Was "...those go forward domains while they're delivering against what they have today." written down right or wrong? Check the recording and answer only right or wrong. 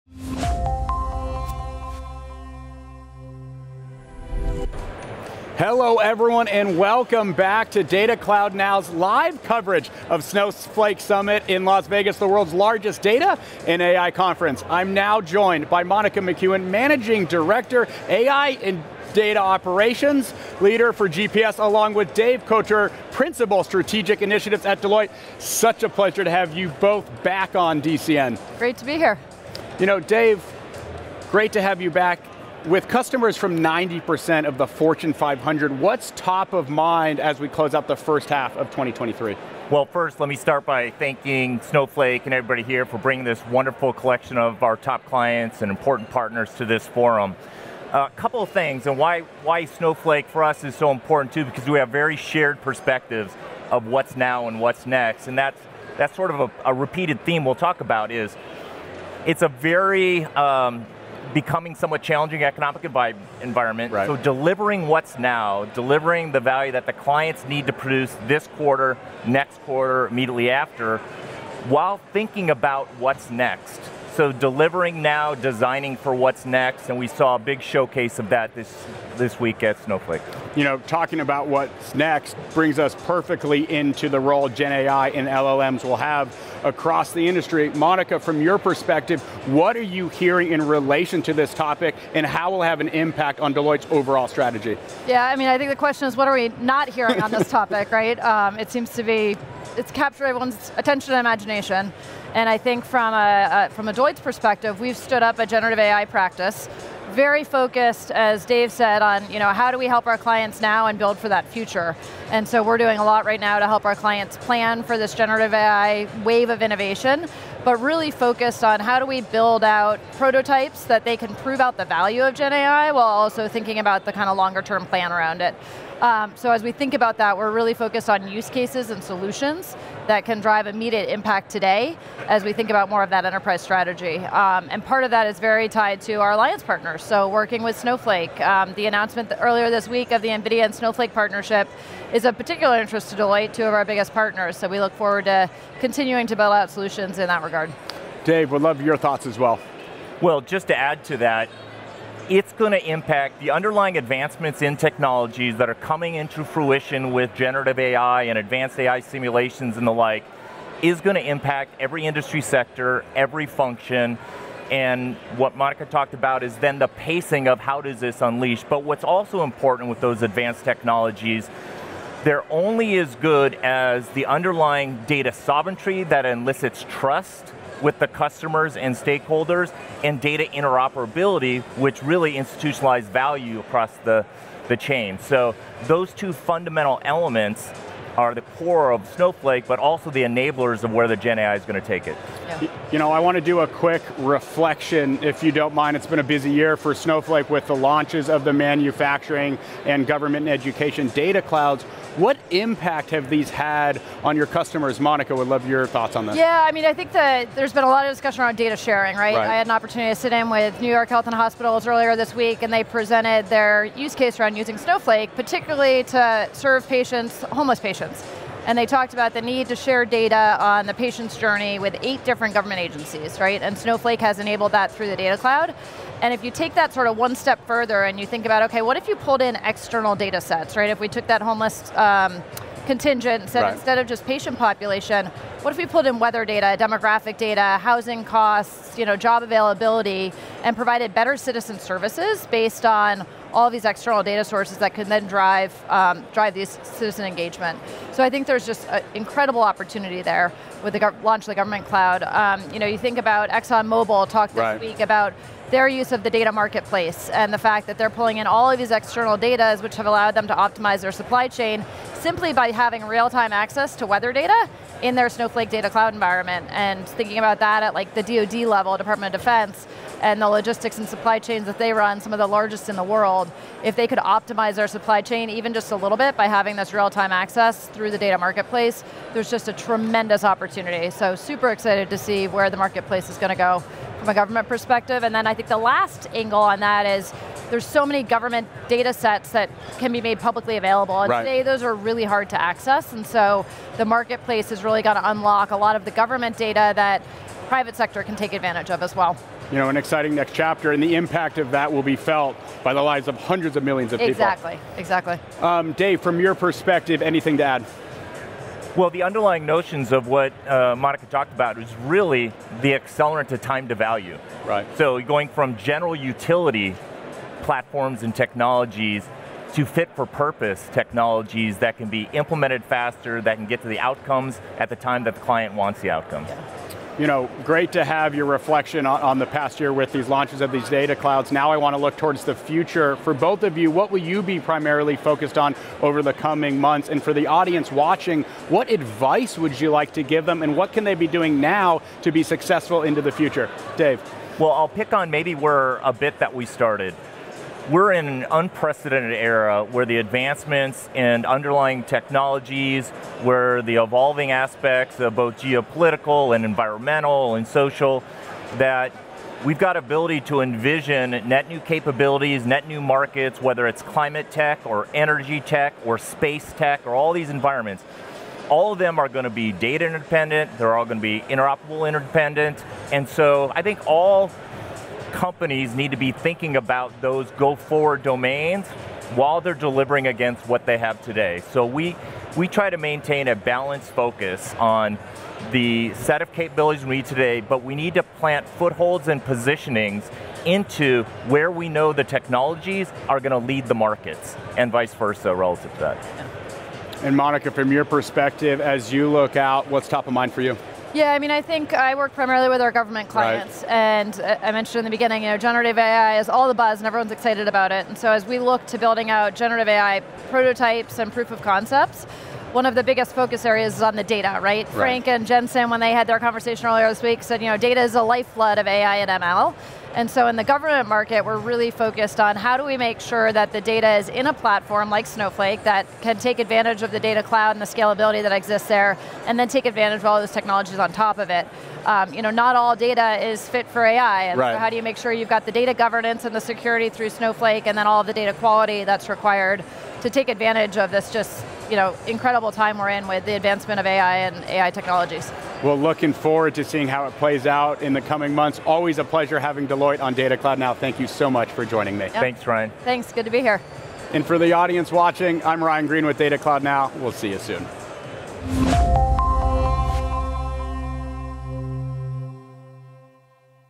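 right.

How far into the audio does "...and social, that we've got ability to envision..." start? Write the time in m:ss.
5:57.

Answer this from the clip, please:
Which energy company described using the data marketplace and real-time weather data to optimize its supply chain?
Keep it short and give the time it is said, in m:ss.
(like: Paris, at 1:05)
ExxonMobil, at 4:13.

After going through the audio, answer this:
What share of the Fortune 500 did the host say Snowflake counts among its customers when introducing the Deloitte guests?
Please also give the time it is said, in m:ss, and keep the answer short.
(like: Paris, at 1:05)
90%, at 0:33.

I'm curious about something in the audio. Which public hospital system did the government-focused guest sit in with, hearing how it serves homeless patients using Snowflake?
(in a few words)
New York Health and Hospitals.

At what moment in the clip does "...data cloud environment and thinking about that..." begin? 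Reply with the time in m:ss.
4:25.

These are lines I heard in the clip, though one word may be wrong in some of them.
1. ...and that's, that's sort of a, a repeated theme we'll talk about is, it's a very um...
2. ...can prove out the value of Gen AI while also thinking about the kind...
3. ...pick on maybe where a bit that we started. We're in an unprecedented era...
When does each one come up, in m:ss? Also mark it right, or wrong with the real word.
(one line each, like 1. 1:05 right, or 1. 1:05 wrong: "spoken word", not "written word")
1. 0:55 right
2. 2:01 right
3. 5:44 right.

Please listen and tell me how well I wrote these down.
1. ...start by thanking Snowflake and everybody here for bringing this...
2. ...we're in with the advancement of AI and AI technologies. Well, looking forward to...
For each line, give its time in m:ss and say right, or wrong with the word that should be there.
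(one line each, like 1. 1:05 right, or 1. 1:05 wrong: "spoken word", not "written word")
1. 0:40 right
2. 7:22 right.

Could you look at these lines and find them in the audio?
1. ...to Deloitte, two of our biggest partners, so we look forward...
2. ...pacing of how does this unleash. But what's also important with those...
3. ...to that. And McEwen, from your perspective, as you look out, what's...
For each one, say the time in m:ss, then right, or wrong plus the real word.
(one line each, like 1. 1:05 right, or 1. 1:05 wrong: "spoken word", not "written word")
1. 2:23 right
2. 2:46 right
3. 6:35 wrong: "Monica", not "McEwen".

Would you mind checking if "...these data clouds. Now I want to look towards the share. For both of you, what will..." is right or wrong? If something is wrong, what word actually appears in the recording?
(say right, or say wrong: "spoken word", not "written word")
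wrong: "future", not "share".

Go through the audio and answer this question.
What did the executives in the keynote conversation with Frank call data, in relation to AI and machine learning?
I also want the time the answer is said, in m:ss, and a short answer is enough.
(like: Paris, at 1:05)
lifeblood, at 6:58.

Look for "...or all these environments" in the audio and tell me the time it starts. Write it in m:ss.
6:07.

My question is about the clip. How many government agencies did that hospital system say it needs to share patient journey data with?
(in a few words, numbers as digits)
8.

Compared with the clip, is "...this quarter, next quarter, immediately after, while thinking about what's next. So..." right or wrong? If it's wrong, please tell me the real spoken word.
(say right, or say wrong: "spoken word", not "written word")
right.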